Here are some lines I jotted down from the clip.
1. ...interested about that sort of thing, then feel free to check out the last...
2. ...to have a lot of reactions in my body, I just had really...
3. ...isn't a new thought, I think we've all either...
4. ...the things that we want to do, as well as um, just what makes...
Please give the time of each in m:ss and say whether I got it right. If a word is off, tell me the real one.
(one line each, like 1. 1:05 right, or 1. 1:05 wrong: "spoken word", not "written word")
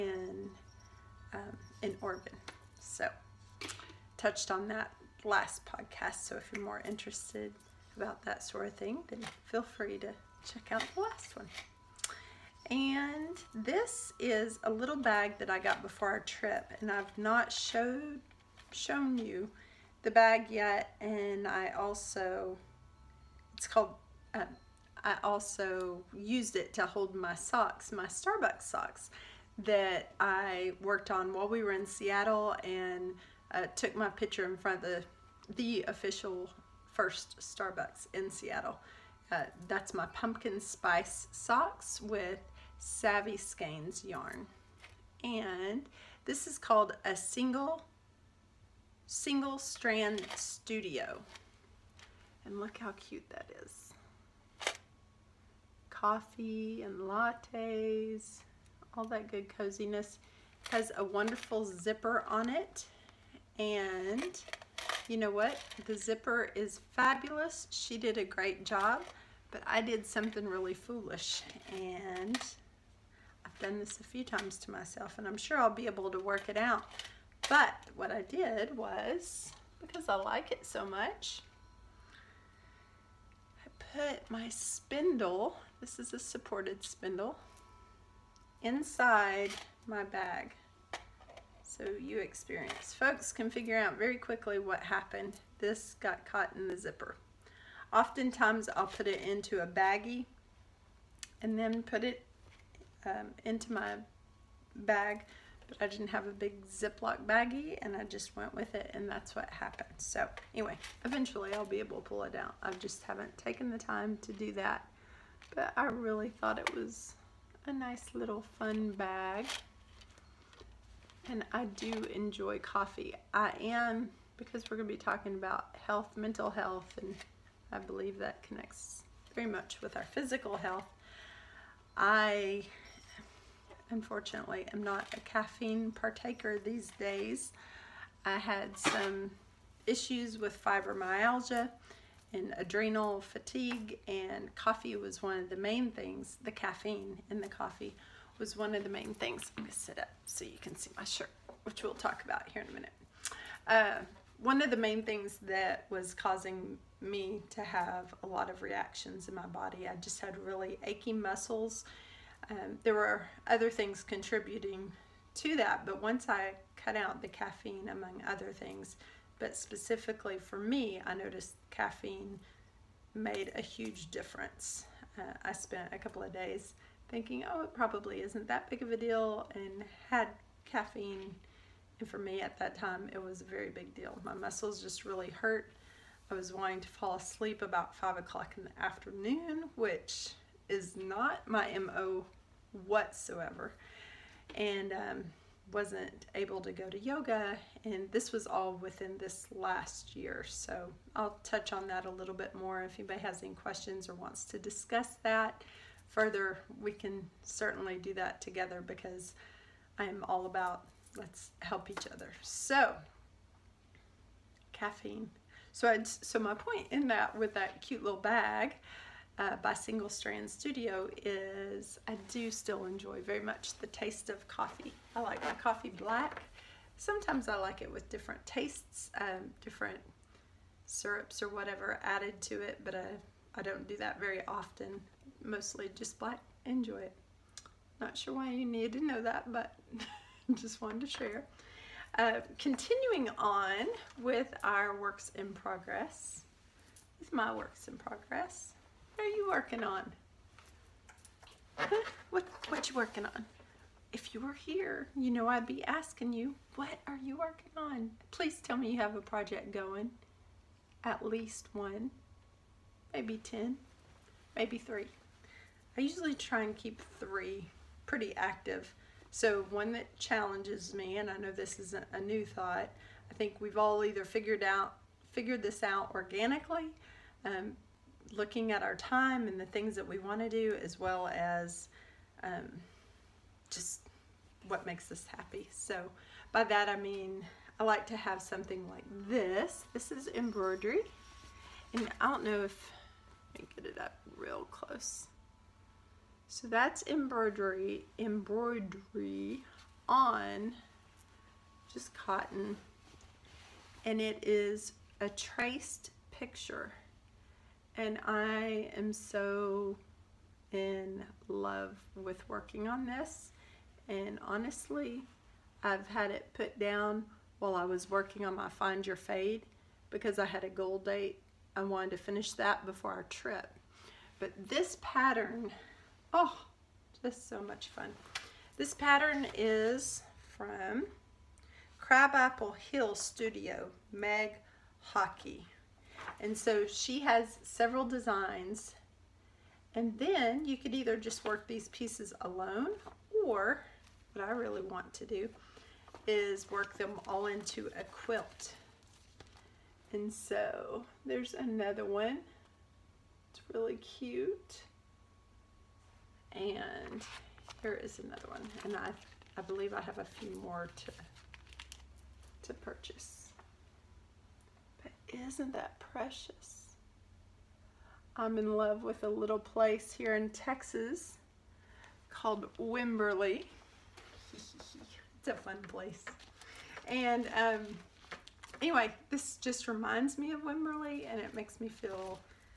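1. 0:06 right
2. 2:37 right
3. 4:31 right
4. 4:39 right.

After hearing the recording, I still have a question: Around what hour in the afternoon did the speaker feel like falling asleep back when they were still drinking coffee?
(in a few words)
5 o'clock.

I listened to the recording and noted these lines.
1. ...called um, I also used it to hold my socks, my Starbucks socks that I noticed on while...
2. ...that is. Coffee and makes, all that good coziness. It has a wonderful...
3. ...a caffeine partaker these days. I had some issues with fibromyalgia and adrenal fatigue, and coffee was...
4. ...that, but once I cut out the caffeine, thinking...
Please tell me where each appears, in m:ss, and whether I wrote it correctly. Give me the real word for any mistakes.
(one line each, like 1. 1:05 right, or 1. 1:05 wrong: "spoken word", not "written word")
1. 0:23 wrong: "worked", not "noticed"
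2. 0:53 wrong: "lattes", not "makes"
3. 2:15 right
4. 2:45 wrong: "among", not "thinking".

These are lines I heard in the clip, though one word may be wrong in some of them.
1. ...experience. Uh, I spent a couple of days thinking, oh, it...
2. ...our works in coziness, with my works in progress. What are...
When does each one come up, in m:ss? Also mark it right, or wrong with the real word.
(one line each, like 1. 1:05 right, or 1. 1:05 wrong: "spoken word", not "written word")
1. 2:54 wrong: "difference", not "experience"
2. 4:04 wrong: "progress", not "coziness".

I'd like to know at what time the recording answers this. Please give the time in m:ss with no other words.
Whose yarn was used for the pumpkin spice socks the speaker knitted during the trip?
0:42.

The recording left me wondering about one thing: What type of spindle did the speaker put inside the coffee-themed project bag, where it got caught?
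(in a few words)
supported spindle.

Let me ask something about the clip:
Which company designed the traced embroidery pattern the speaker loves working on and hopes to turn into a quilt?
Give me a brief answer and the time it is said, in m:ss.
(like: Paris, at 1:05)
Crabapple Hill Studio, at 5:31.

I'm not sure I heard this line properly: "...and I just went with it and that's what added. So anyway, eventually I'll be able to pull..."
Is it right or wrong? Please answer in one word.
wrong.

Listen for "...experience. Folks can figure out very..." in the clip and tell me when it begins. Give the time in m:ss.
1:32.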